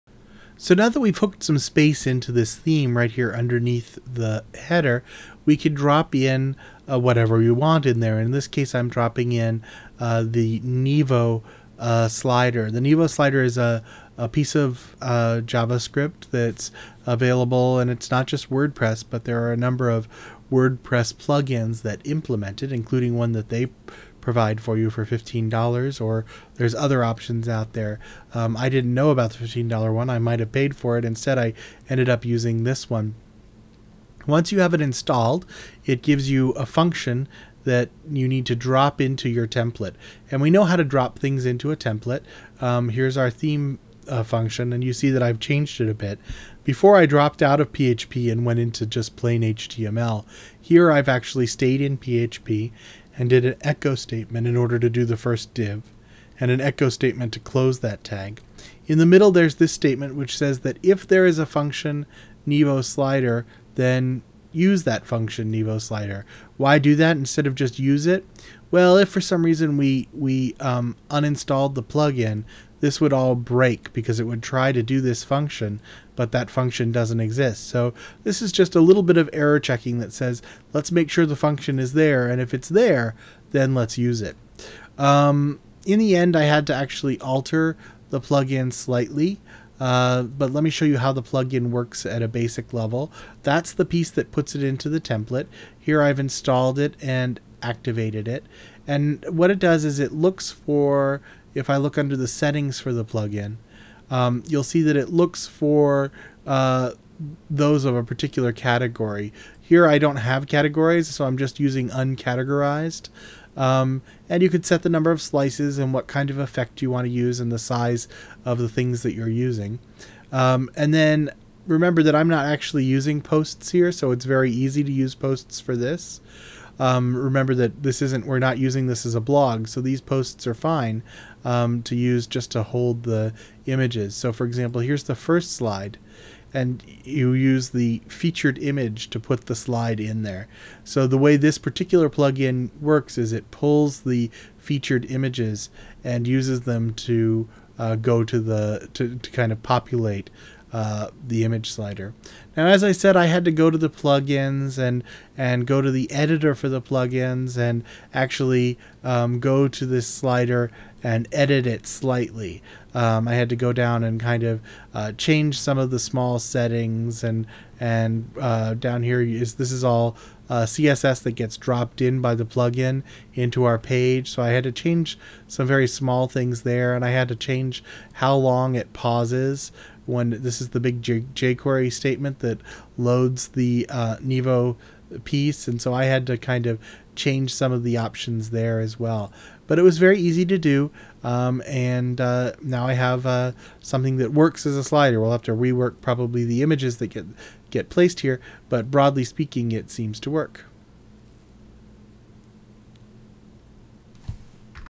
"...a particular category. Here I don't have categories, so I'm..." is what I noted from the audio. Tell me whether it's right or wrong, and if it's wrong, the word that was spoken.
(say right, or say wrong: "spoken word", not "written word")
right.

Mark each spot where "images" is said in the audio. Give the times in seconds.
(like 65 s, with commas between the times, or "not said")
133 s, 138 s, 145 s, 151 s, 196 s.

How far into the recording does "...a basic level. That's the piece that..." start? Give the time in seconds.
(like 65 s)
92 s.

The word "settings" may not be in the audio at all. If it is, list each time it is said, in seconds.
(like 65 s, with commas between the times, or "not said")
102 s, 166 s.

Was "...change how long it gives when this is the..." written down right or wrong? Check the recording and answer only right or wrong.
wrong.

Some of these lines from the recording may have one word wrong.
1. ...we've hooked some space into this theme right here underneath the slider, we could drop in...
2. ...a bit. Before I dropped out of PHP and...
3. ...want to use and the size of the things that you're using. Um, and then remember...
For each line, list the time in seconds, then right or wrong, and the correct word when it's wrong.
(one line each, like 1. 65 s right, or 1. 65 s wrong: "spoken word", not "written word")
1. 0 s wrong: "header", not "slider"
2. 45 s right
3. 116 s right.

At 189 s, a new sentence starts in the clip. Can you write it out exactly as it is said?
But it was very easy to do, um, and uh, now I have uh, something that works as a slider.